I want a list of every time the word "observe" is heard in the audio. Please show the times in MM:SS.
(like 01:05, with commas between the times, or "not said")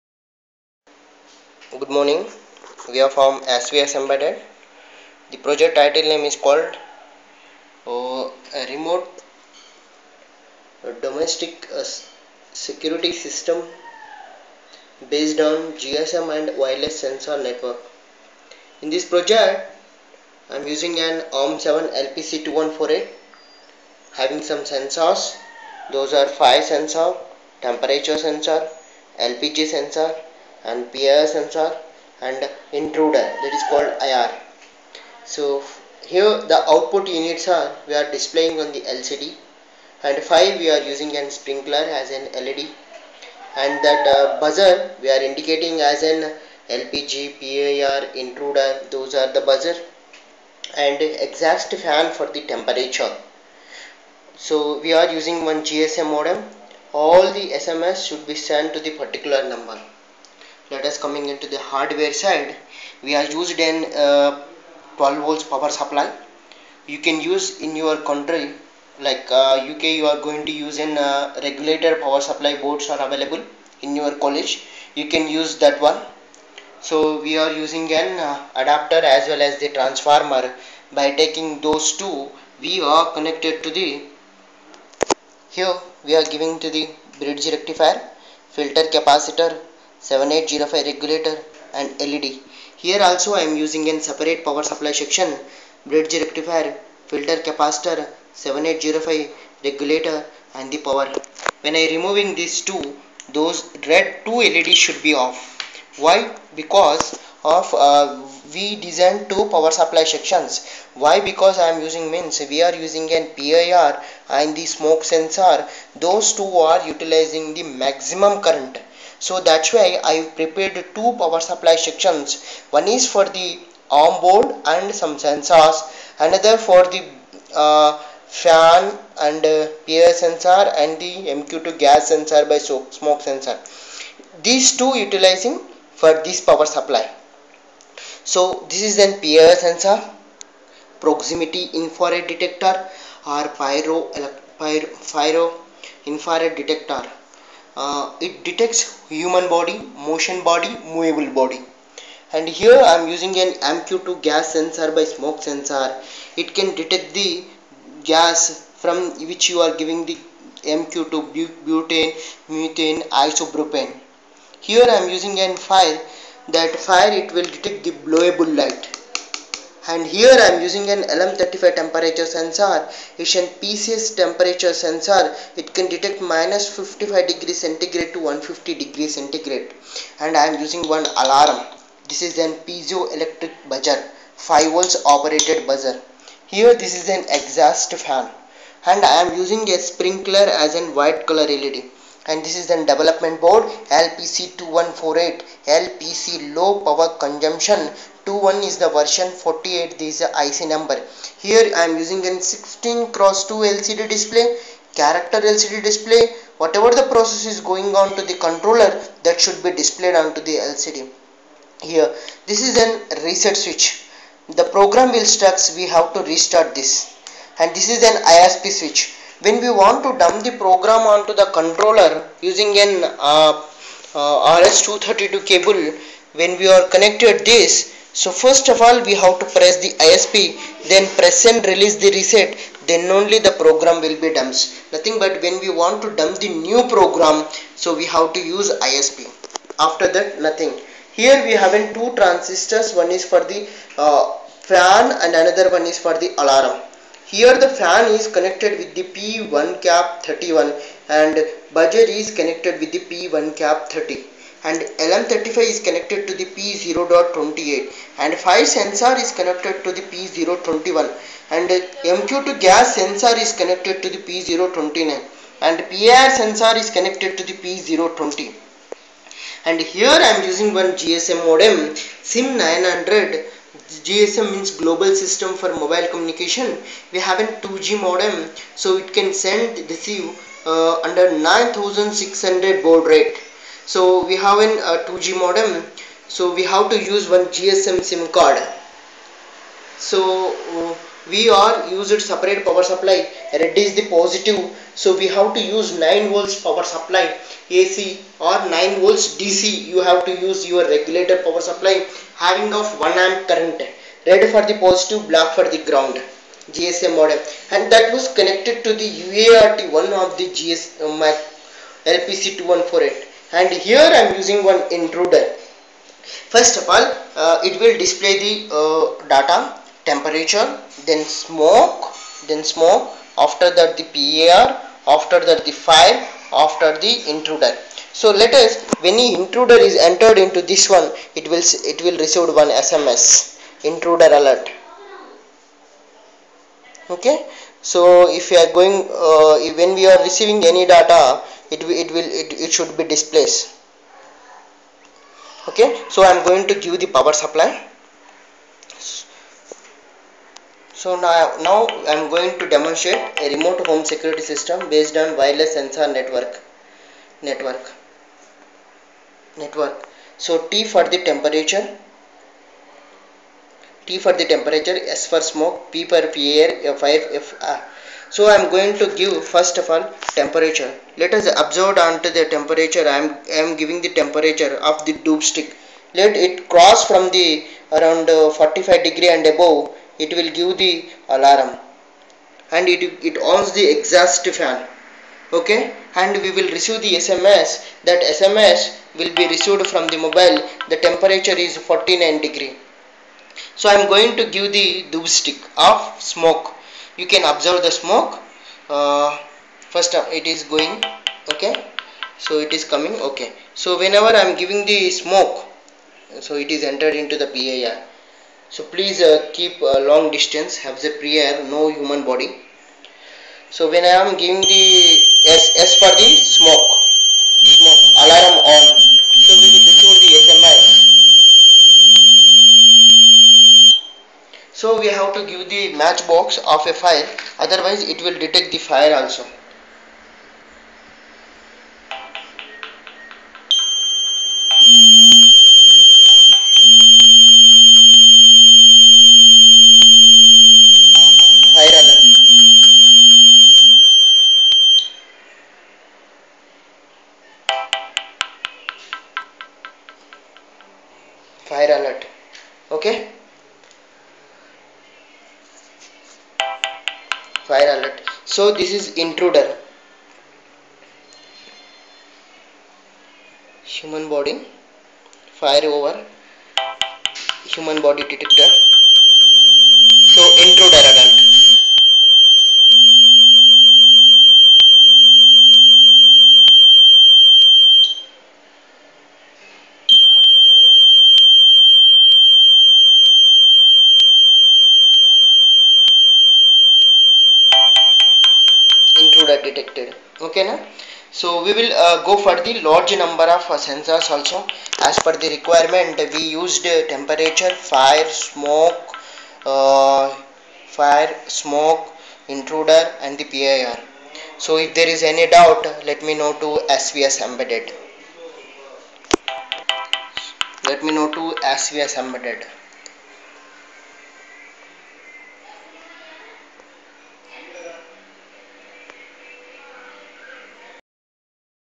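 06:11, 06:37.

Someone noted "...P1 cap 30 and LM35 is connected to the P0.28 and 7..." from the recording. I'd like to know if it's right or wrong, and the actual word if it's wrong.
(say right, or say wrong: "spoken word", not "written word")
wrong: "5", not "7".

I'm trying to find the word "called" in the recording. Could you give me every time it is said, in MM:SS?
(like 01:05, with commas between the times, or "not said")
00:06, 00:33.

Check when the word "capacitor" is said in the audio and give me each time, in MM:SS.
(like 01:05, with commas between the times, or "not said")
01:28, 01:37.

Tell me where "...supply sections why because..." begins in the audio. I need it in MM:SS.
01:49.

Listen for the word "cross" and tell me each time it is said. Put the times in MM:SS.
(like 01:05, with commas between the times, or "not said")
03:23, 06:16.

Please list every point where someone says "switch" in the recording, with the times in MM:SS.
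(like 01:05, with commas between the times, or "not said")
03:33, 03:38.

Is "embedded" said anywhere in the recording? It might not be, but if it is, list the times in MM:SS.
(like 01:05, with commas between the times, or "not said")
00:03, 08:27, 08:32.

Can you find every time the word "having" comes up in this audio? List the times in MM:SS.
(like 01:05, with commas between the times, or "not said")
00:24, 04:01, 05:02.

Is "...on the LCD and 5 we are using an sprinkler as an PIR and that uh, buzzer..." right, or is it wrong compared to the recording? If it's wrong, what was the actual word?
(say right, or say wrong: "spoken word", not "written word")
wrong: "LED", not "PIR".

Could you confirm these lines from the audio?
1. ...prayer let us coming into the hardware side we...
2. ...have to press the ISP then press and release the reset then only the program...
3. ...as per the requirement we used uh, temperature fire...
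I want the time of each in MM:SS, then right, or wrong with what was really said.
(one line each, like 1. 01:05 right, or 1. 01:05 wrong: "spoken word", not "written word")
1. 00:59 wrong: "number", not "prayer"
2. 03:49 right
3. 08:15 right.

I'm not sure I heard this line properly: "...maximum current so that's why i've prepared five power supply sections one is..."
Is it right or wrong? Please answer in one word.
wrong.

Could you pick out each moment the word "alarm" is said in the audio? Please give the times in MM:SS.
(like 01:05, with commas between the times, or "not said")
03:01, 04:06, 06:21, 06:58.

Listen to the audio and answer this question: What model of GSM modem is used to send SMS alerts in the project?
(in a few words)
SIM 900.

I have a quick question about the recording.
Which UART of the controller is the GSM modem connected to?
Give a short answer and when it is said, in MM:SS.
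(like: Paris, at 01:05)
UART1, at 05:09.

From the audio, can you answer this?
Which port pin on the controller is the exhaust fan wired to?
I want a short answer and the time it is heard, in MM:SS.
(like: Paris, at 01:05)
P1.31, at 04:09.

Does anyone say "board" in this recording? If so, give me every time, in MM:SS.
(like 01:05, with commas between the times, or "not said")
01:12, 02:04, 03:13.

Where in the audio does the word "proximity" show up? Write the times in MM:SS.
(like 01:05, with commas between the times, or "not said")
02:21.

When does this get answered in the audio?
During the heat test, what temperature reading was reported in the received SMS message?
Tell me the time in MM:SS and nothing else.
06:31.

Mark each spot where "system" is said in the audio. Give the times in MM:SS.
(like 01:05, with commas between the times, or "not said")
00:13, 04:35, 05:54.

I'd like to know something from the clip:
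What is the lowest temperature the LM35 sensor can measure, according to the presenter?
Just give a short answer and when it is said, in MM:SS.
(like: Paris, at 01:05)
-55 degrees centigrade, at 02:56.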